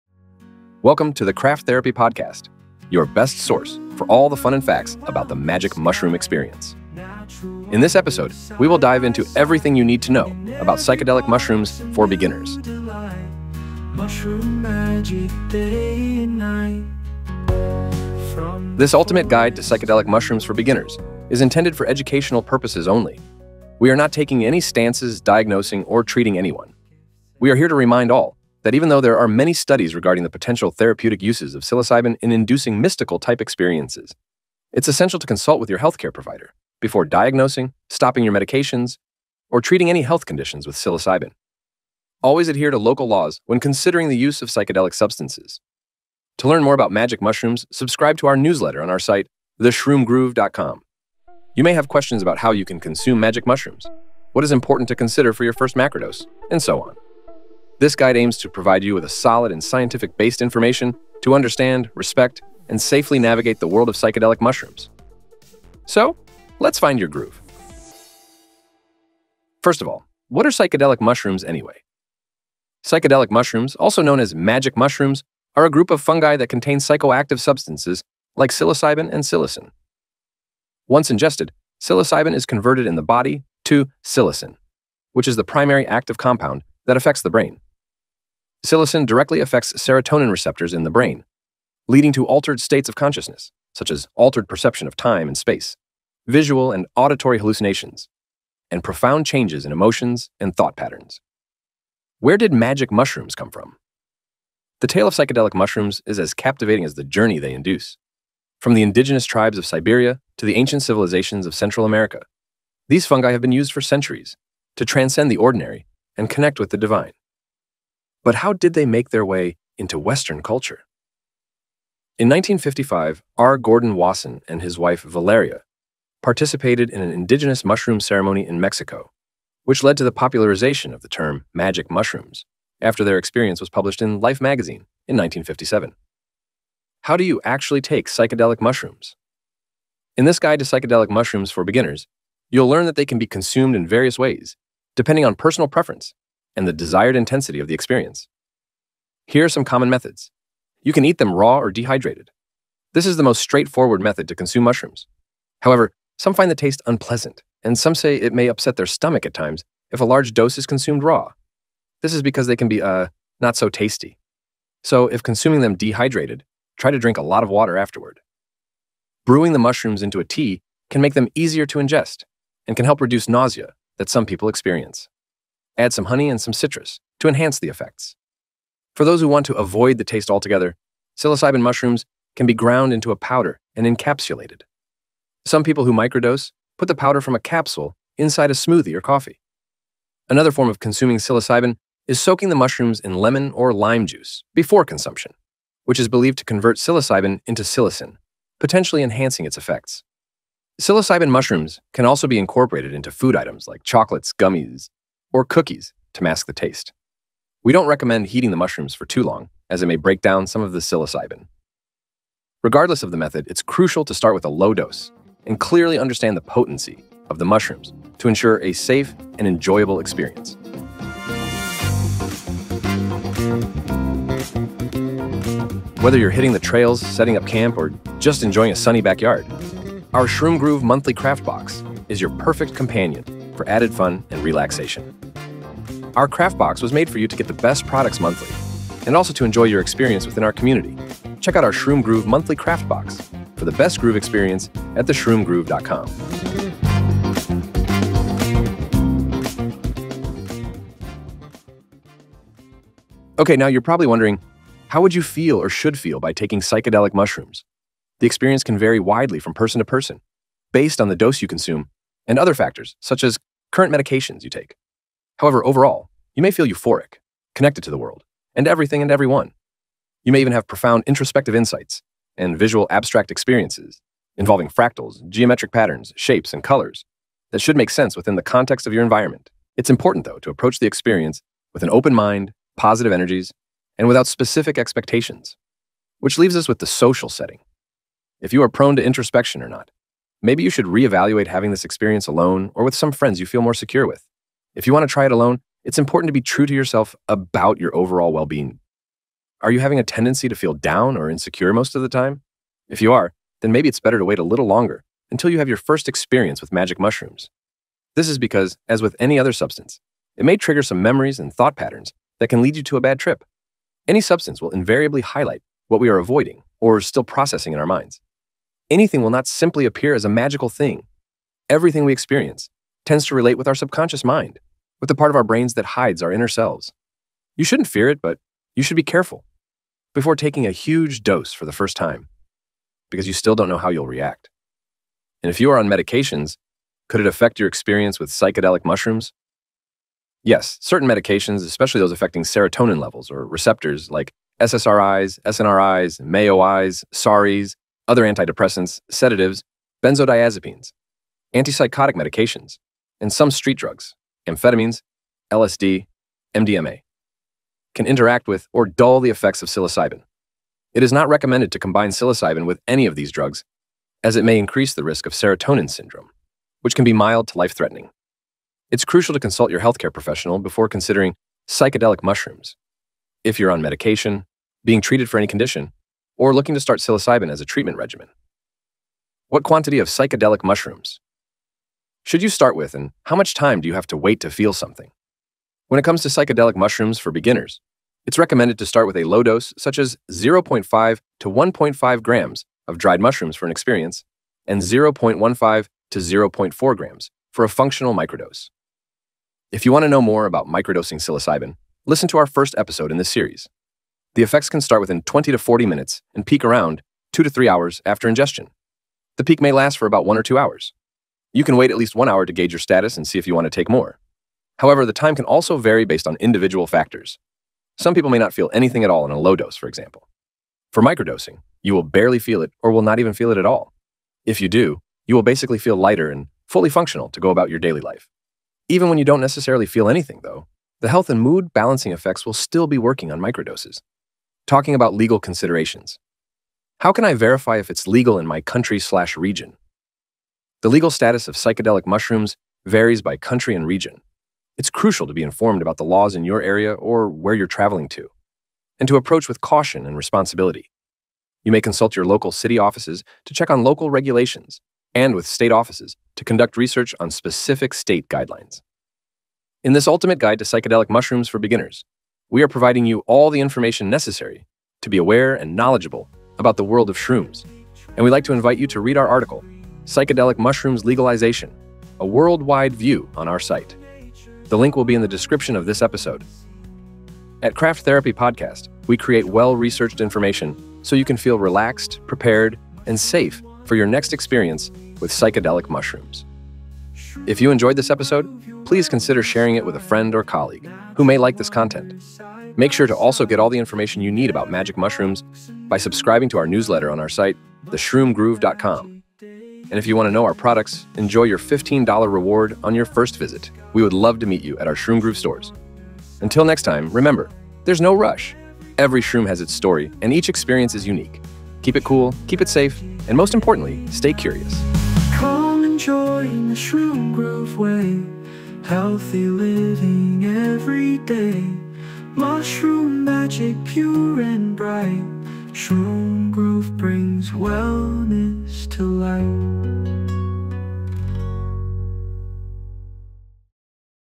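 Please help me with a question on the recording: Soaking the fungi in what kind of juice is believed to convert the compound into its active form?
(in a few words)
Lemon or lime juice.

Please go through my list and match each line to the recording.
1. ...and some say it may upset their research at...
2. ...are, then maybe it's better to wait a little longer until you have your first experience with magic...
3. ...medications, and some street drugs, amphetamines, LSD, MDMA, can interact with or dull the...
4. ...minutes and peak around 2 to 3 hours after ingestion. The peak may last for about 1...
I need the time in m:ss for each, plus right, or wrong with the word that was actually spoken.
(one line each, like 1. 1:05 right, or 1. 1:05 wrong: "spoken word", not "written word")
1. 2:37 wrong: "stomach", not "research"
2. 5:03 right
3. 5:52 right
4. 6:45 right.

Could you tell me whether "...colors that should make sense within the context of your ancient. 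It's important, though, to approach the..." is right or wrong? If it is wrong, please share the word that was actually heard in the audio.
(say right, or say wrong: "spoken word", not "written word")
wrong: "environment", not "ancient".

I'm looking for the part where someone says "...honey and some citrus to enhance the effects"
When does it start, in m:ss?
2:56.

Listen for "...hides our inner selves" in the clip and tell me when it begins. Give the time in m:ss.
5:25.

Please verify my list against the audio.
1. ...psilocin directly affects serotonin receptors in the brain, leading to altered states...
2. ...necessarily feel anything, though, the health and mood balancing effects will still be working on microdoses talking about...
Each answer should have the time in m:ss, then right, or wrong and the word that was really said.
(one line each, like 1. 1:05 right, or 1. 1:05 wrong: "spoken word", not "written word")
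1. 1:28 right
2. 7:09 right.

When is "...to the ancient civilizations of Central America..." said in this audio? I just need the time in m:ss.
1:50.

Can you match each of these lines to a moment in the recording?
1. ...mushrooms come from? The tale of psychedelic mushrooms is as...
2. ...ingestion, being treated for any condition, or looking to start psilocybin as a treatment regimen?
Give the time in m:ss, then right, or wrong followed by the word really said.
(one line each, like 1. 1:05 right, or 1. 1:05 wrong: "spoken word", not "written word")
1. 1:42 right
2. 6:13 wrong: "medication", not "ingestion".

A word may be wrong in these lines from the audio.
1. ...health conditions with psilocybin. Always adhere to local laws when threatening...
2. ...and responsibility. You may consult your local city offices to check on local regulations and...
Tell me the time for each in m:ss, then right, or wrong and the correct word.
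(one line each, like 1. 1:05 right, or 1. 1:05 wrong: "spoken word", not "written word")
1. 0:40 wrong: "considering", not "threatening"
2. 7:30 right.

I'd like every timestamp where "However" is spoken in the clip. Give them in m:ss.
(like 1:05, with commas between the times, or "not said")
2:35, 4:25, 6:54.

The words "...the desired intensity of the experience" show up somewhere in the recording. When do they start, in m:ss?
2:26.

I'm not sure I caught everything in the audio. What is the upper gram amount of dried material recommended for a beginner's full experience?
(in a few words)
1.5 grams.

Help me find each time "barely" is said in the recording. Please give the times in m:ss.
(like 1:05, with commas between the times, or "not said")
7:02.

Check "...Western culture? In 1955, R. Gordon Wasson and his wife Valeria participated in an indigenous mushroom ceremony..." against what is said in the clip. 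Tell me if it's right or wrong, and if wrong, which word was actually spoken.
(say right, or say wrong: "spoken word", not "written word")
right.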